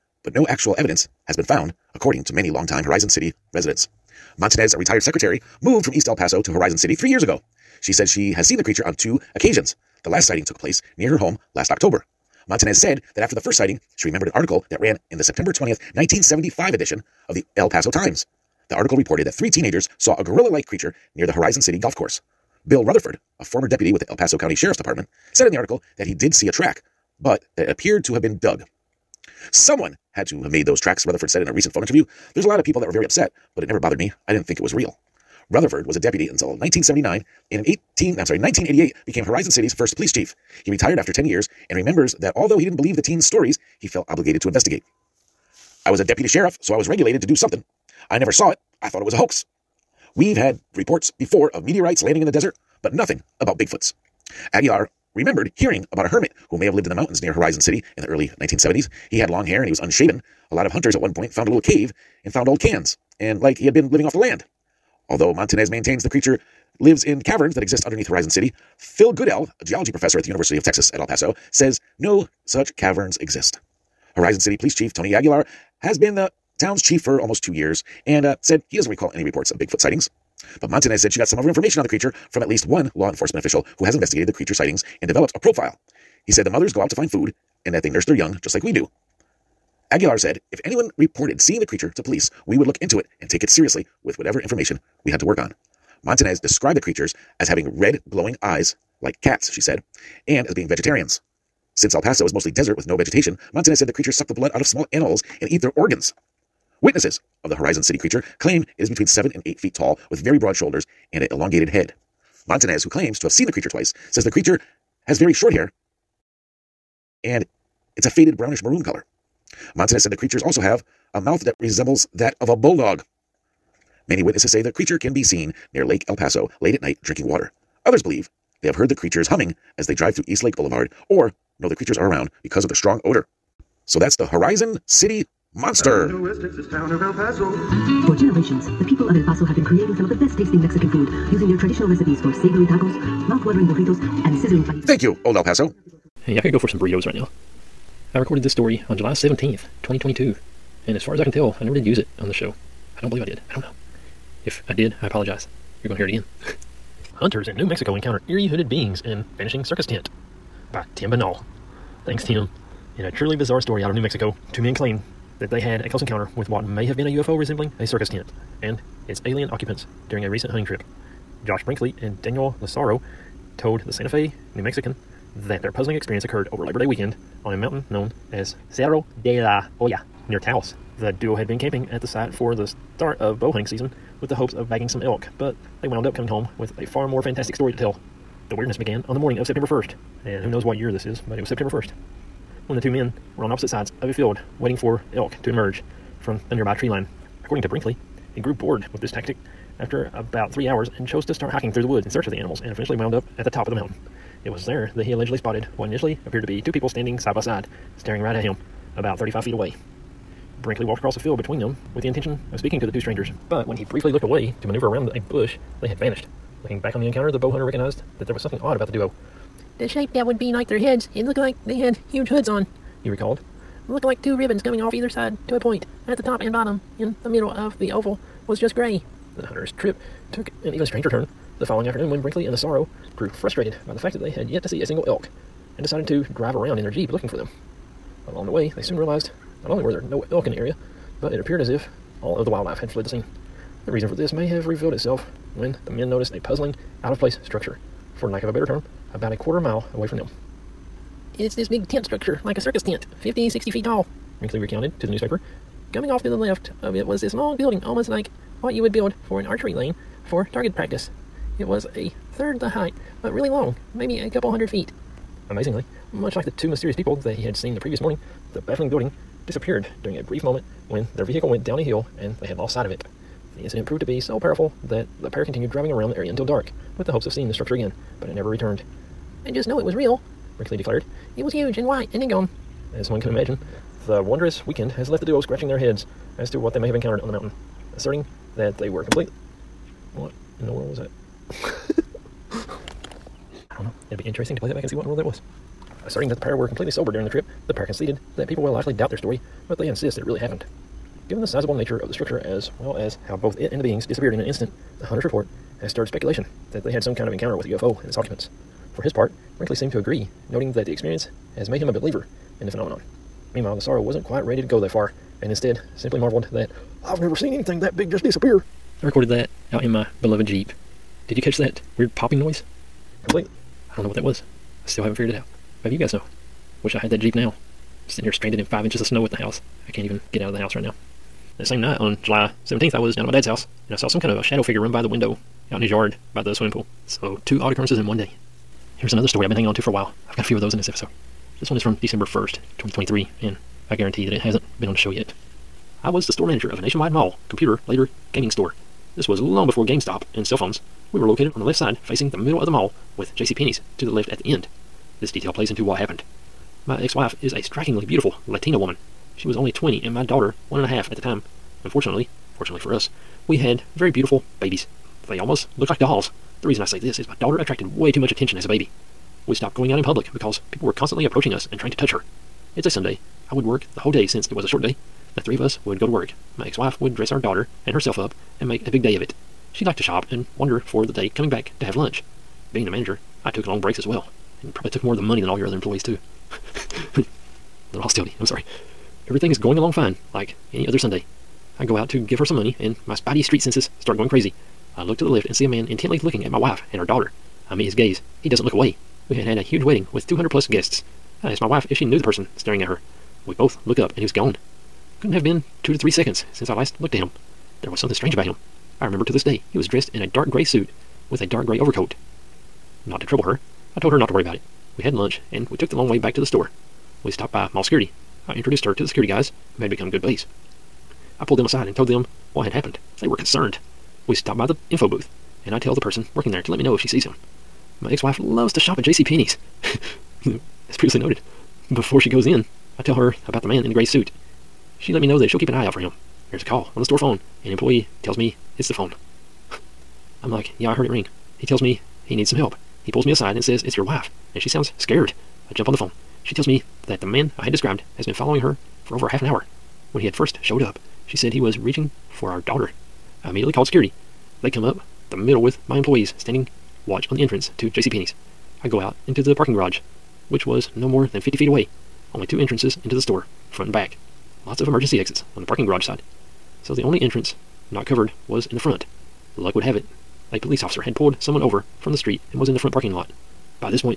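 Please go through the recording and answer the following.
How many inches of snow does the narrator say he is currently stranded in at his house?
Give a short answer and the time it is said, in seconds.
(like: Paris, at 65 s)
5 inches, at 328 s.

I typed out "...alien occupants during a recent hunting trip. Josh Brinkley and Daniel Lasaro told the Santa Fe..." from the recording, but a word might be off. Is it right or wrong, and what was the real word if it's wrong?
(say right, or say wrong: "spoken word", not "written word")
right.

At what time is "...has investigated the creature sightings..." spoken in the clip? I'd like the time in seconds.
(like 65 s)
83 s.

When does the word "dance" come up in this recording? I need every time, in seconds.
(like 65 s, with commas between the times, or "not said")
not said.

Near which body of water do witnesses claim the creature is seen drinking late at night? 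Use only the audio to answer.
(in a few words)
Lake El Paso.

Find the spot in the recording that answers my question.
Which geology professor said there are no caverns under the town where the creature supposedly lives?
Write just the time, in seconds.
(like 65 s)
68 s.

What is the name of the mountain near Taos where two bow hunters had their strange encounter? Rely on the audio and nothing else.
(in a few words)
Cerro de la Olla.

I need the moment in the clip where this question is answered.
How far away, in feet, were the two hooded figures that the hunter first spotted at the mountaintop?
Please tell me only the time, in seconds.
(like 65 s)
209 s.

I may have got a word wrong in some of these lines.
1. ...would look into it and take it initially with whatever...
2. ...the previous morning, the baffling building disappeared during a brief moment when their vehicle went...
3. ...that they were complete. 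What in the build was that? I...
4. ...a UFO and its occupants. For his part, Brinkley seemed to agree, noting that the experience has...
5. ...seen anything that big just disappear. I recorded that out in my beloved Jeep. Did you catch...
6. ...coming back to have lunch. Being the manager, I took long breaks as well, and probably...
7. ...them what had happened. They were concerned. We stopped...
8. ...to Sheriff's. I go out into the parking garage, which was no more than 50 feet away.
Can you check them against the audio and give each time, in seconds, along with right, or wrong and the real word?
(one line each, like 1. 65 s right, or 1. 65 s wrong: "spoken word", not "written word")
1. 92 s wrong: "seriously", not "initially"
2. 267 s right
3. 288 s wrong: "world", not "build"
4. 307 s right
5. 317 s right
6. 381 s right
7. 422 s right
8. 457 s wrong: "JCPenney", not "Sheriff".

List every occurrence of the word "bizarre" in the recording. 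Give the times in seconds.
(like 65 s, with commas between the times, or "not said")
163 s.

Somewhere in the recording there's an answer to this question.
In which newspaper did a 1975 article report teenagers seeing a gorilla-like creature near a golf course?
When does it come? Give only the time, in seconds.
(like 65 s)
17 s.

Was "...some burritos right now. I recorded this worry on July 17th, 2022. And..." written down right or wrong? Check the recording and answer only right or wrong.
wrong.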